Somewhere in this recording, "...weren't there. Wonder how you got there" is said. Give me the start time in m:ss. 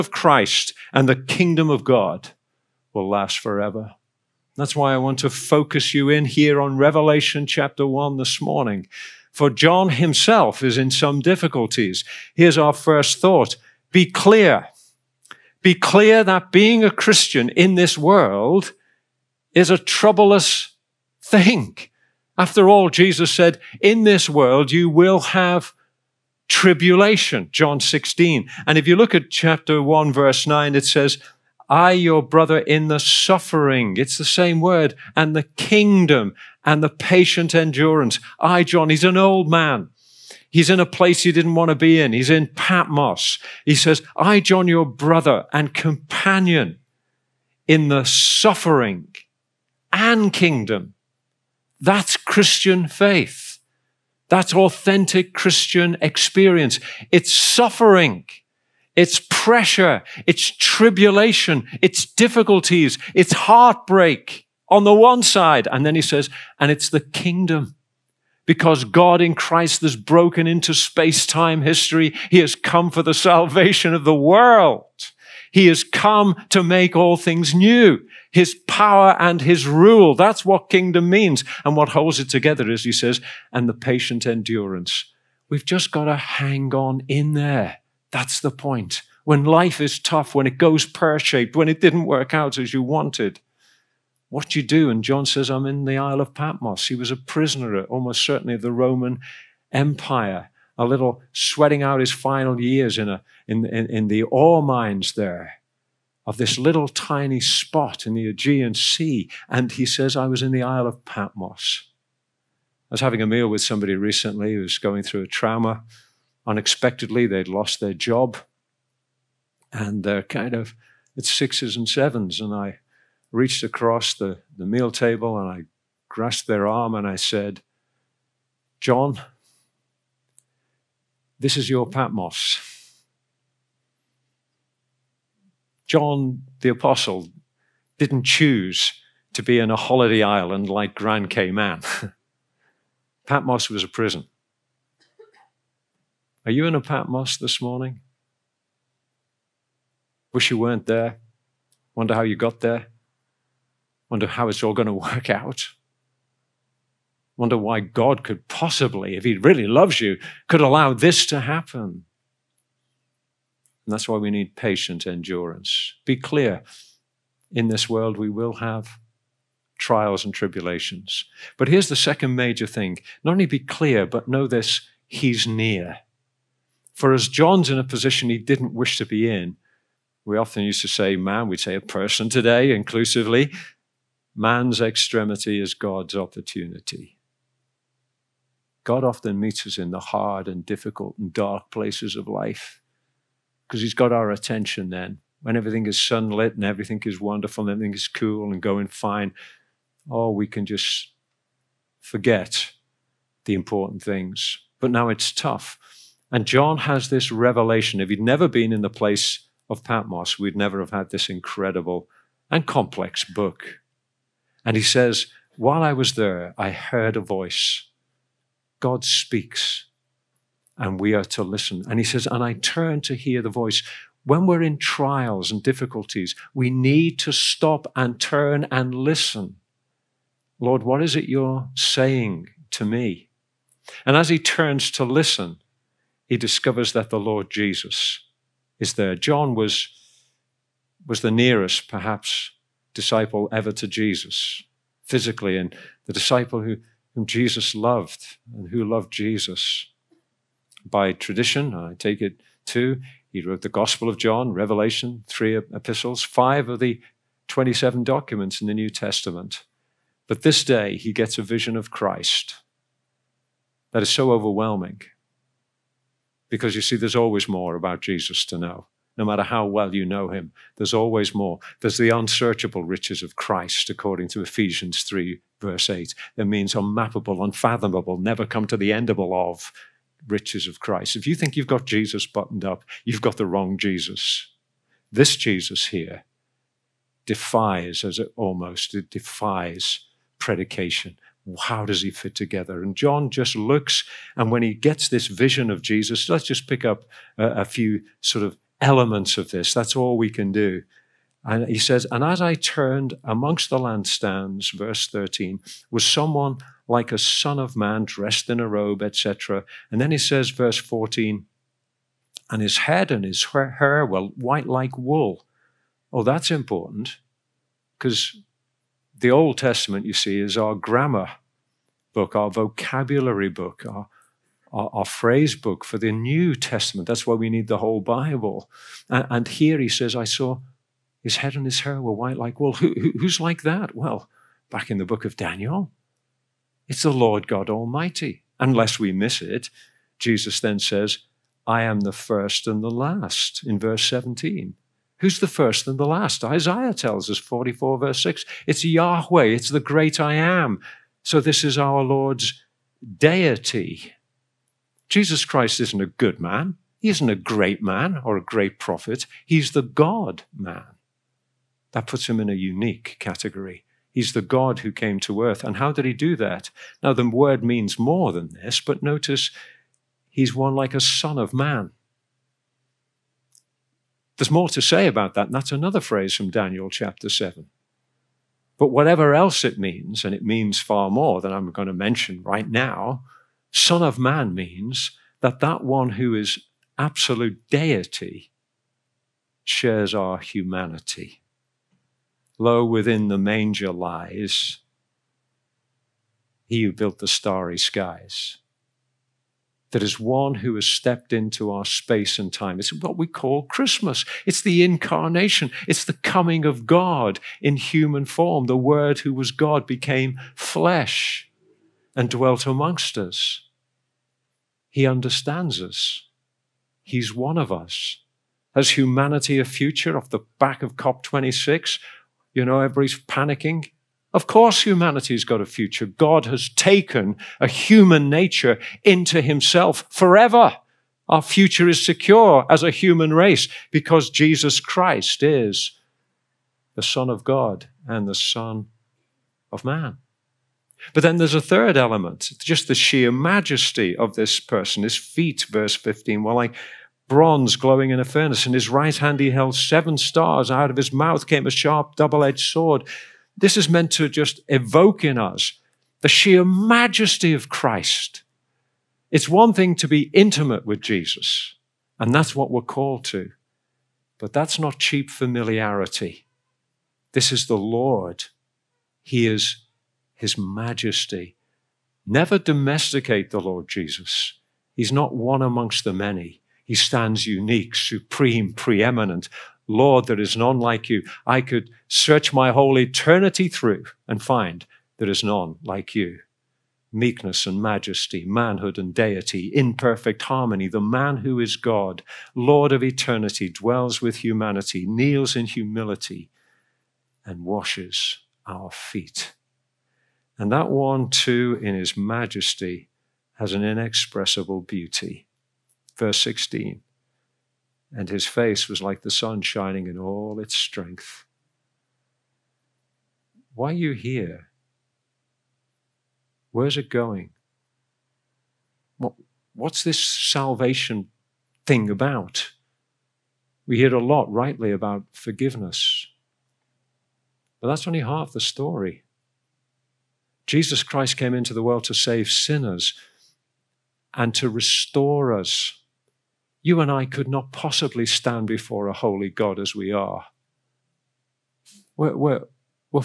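2:30.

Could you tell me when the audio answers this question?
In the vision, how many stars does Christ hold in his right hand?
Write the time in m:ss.
7:29.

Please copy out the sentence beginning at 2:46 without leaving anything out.
Be clear in this world, we will have trials and tribulations.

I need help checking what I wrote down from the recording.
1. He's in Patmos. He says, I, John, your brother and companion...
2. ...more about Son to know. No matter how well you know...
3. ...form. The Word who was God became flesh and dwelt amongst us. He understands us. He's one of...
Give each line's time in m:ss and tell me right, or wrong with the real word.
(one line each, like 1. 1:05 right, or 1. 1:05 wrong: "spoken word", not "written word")
1. 0:42 right
2. 4:27 wrong: "Jesus", not "Son"
3. 6:48 right.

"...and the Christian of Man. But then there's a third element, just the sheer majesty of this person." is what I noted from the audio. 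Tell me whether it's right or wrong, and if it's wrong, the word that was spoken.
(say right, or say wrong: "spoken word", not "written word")
wrong: "Son", not "Christian".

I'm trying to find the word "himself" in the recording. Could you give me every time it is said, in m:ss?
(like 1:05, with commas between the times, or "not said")
0:09, 7:09.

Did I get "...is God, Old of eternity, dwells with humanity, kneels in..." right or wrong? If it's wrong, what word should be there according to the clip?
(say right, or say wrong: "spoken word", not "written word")
wrong: "Lord", not "Old".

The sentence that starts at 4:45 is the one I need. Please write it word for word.
This Jesus here defies, as it almost, it defies predication.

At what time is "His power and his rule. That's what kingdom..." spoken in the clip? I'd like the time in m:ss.
1:18.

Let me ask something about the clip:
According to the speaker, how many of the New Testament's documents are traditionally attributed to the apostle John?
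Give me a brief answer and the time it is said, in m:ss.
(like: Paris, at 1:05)
5, at 4:16.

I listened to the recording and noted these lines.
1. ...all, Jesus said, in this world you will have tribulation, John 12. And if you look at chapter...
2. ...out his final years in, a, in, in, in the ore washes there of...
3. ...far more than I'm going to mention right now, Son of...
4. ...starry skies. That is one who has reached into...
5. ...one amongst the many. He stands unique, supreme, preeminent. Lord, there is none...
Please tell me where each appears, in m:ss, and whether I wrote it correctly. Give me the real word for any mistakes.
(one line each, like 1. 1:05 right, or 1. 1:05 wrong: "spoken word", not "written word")
1. 0:22 wrong: "16", not "12"
2. 1:41 wrong: "mines", not "washes"
3. 6:20 right
4. 6:37 wrong: "stepped", not "reached"
5. 7:55 right.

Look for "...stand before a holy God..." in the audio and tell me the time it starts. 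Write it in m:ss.
8:58.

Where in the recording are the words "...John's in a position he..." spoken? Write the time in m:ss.
2:57.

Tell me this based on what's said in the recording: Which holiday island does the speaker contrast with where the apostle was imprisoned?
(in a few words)
Grand Cayman.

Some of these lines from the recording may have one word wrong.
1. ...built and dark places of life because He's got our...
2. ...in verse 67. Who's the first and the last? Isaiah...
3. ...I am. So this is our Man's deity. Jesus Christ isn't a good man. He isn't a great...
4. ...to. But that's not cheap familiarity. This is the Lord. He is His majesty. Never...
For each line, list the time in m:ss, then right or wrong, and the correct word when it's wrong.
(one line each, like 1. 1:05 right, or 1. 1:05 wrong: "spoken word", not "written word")
1. 3:10 wrong: "difficult", not "built"
2. 5:43 wrong: "17", not "67"
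3. 5:50 wrong: "Lord", not "Man"
4. 7:43 right.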